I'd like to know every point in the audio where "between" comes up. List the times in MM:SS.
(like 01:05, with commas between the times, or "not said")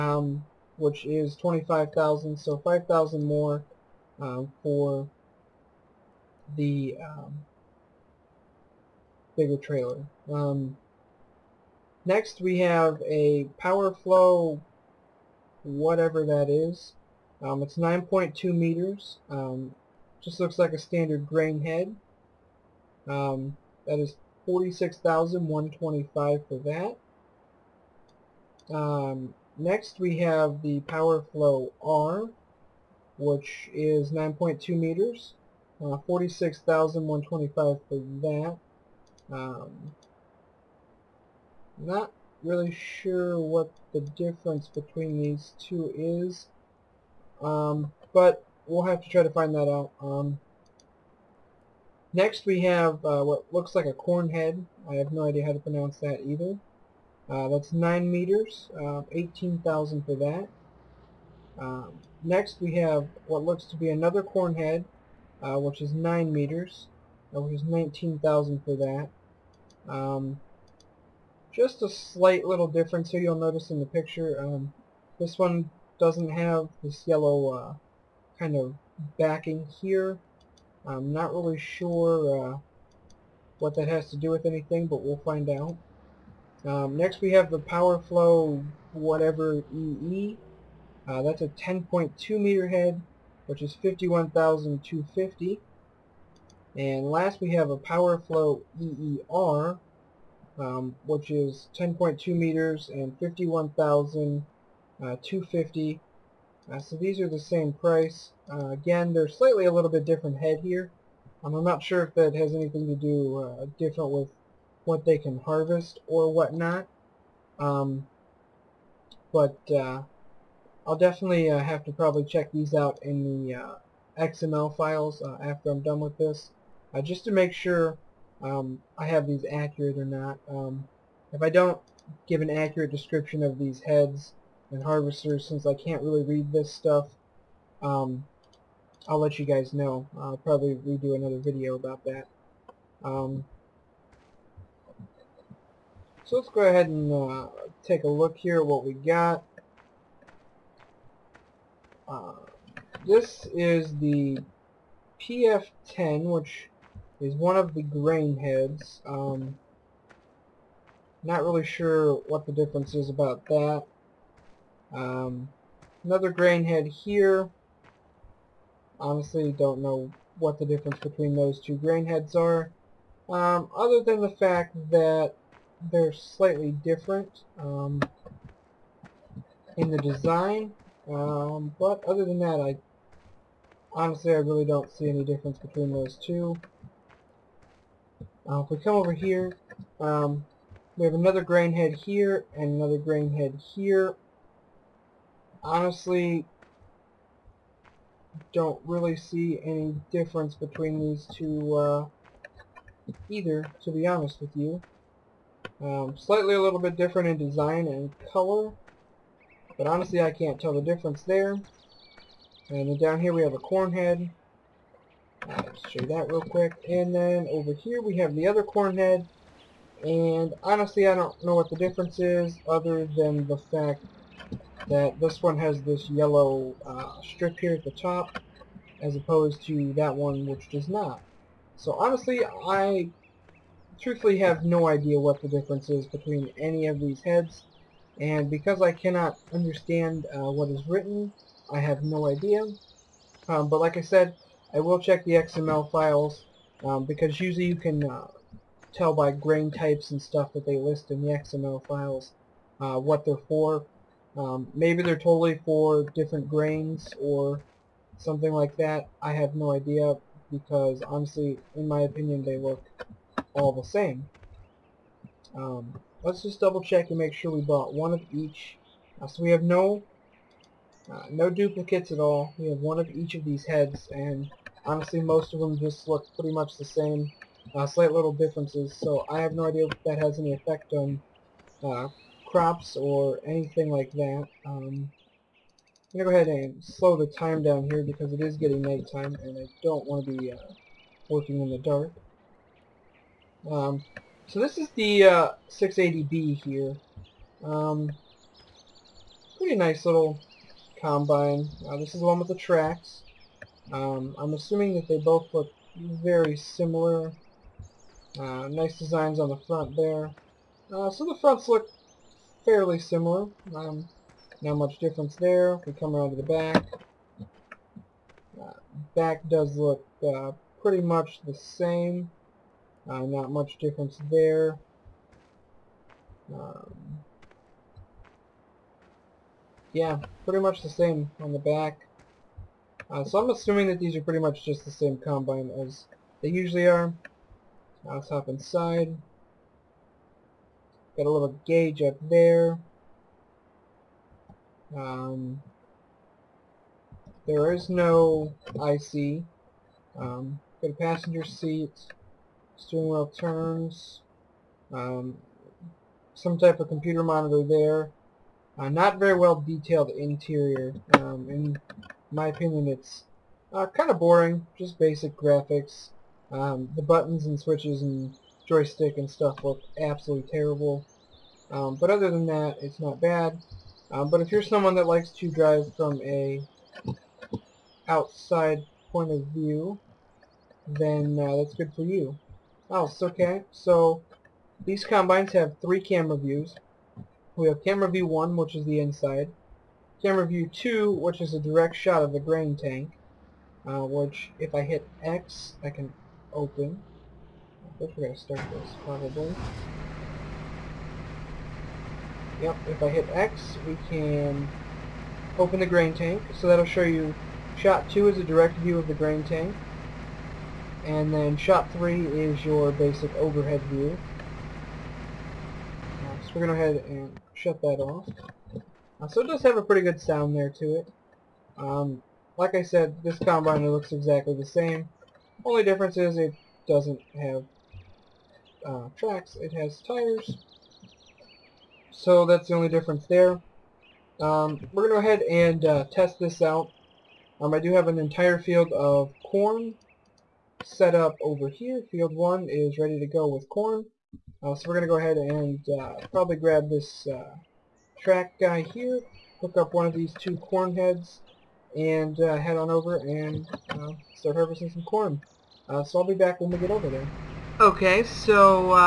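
00:44, 02:50, 03:05, 03:20, 03:56.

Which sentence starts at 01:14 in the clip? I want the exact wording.
Um, this one doesn't have this yellow uh, kind of backing here.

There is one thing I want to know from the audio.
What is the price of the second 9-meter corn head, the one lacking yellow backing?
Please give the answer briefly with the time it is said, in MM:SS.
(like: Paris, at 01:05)
19,000, at 01:07.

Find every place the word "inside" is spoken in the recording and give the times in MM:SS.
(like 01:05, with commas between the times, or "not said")
05:38, 06:29.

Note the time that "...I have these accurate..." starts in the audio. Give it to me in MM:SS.
02:08.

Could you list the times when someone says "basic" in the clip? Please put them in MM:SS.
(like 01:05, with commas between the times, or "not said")
06:04, 06:52.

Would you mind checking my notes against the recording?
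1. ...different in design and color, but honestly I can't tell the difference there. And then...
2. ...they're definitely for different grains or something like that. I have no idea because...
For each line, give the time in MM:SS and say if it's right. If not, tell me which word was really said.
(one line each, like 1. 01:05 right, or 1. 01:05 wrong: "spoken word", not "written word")
1. 03:26 right
2. 04:15 wrong: "totally", not "definitely".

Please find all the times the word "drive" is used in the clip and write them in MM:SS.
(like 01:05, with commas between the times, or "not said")
06:15.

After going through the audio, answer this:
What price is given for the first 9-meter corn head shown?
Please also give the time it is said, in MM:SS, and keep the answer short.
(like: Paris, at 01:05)
18,000, at 00:59.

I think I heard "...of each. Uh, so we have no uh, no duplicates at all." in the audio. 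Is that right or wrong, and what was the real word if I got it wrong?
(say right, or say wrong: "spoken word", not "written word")
right.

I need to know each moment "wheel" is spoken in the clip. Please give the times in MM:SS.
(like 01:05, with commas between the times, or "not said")
05:53.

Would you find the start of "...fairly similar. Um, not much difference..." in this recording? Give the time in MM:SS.
05:12.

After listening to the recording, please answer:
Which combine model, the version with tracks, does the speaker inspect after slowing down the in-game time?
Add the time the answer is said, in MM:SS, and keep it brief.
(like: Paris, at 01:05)
680B, at 04:55.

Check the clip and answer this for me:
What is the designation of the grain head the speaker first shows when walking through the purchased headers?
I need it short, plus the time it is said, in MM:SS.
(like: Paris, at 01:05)
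PF-10, at 02:35.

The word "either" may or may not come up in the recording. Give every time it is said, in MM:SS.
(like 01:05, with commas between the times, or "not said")
00:56, 03:23.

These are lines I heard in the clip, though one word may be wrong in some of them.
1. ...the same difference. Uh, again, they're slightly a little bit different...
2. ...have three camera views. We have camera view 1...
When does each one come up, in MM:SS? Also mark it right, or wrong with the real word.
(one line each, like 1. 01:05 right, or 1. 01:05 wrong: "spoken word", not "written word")
1. 01:47 wrong: "price", not "difference"
2. 06:25 right.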